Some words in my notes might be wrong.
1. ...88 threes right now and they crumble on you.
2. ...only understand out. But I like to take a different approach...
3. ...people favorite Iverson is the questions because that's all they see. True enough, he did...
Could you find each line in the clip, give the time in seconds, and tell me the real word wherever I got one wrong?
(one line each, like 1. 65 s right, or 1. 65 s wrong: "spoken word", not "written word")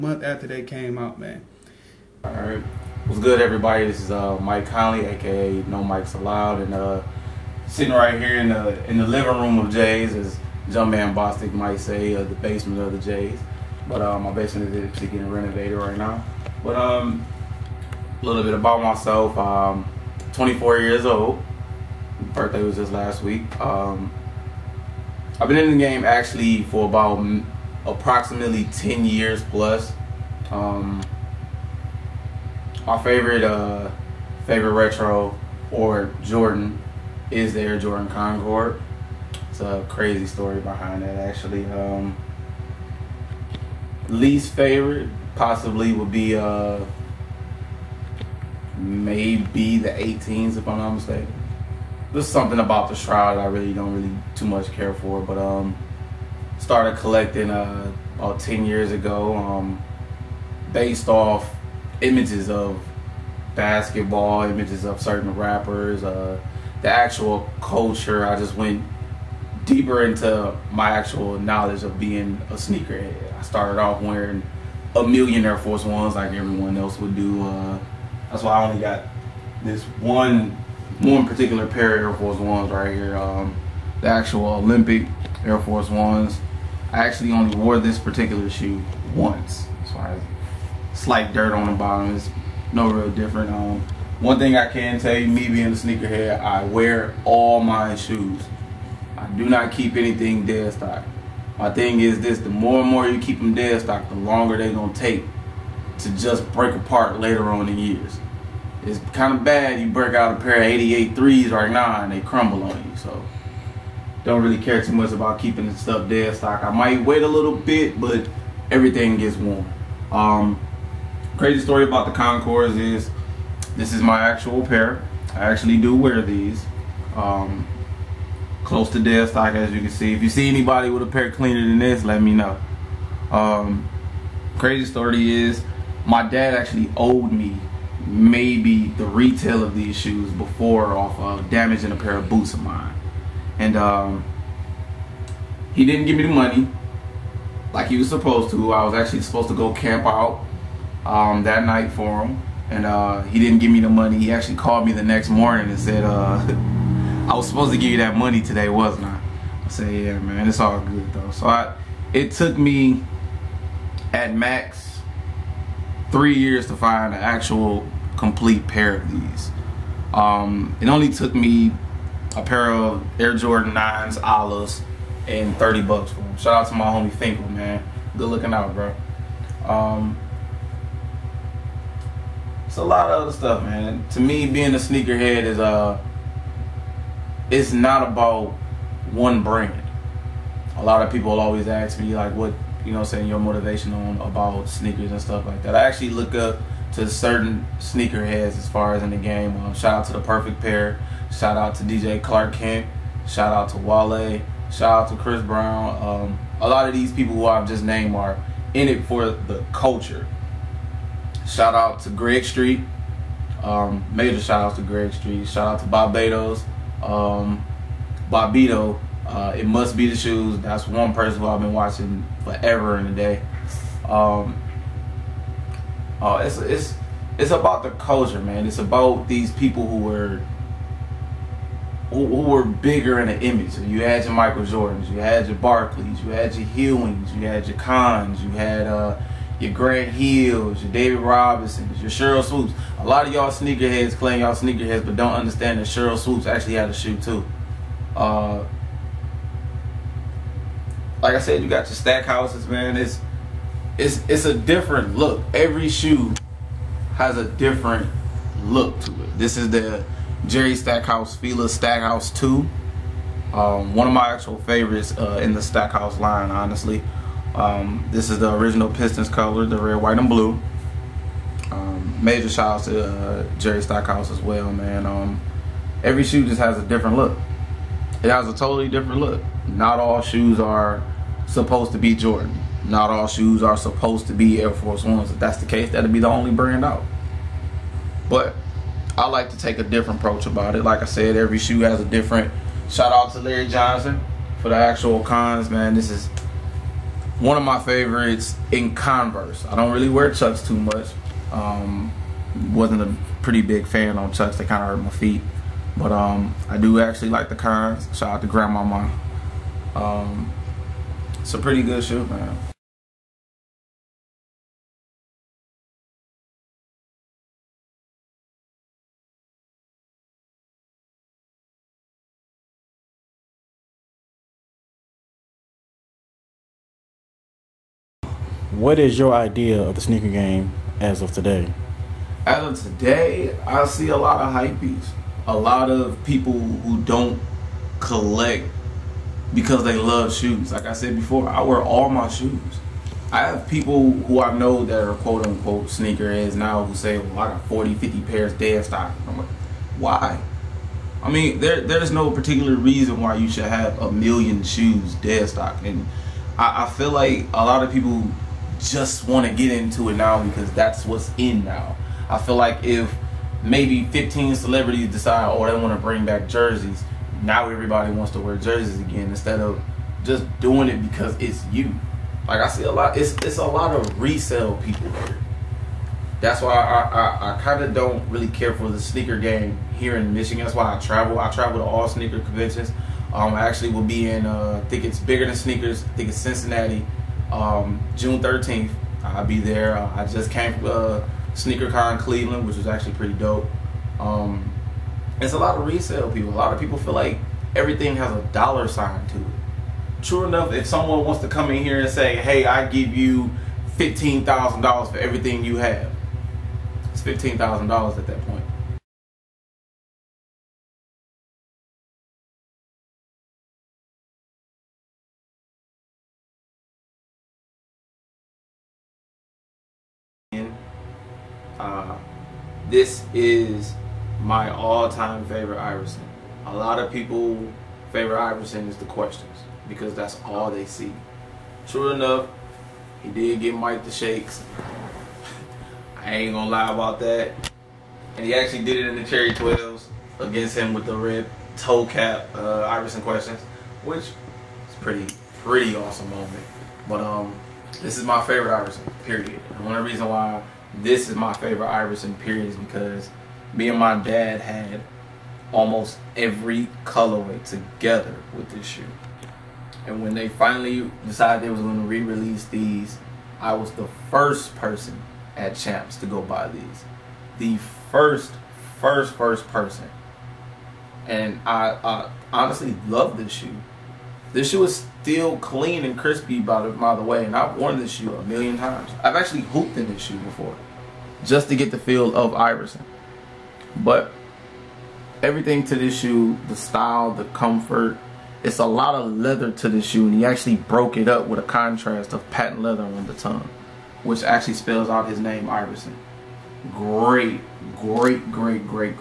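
1. 110 s right
2. 286 s wrong: "brand", not "understand"
3. 427 s right.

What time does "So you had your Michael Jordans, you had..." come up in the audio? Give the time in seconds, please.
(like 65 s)
233 s.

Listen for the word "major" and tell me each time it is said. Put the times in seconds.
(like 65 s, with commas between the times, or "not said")
214 s, 272 s.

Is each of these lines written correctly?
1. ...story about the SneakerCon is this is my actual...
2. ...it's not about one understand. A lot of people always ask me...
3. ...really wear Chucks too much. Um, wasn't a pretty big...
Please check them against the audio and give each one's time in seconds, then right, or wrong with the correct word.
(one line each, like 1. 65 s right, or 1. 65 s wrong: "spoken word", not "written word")
1. 121 s wrong: "Concords", not "SneakerCon"
2. 187 s wrong: "brand", not "understand"
3. 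299 s right.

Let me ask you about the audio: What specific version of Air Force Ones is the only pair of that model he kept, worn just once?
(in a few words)
Olympic.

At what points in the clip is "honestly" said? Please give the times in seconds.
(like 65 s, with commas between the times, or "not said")
266 s, 472 s.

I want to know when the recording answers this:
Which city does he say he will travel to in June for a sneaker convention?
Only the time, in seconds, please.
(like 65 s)
386 s.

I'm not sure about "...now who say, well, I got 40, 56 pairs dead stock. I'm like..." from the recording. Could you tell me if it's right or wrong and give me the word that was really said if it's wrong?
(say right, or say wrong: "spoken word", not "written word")
wrong: "50", not "56".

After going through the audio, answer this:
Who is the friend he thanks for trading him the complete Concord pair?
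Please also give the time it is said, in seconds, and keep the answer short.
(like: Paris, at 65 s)
Finkel, at 177 s.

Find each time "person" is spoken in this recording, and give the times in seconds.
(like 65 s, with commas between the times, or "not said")
221 s, 464 s, 469 s.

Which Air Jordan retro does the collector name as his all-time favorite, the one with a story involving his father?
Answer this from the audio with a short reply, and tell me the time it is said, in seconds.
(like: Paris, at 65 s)
Air Jordan Concord, at 37 s.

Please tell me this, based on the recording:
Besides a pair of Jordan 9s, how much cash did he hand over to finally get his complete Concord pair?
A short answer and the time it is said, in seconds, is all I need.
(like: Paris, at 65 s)
30 bucks, at 175 s.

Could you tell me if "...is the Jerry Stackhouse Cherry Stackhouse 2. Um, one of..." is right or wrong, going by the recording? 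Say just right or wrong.
wrong.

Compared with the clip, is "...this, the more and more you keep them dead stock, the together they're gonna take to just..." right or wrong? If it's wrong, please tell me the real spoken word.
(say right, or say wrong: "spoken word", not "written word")
wrong: "longer", not "together".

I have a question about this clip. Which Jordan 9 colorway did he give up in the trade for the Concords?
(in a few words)
olives.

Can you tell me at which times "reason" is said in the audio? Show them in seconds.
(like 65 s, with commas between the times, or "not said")
352 s, 450 s.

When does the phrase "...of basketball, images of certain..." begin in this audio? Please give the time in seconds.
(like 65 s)
62 s.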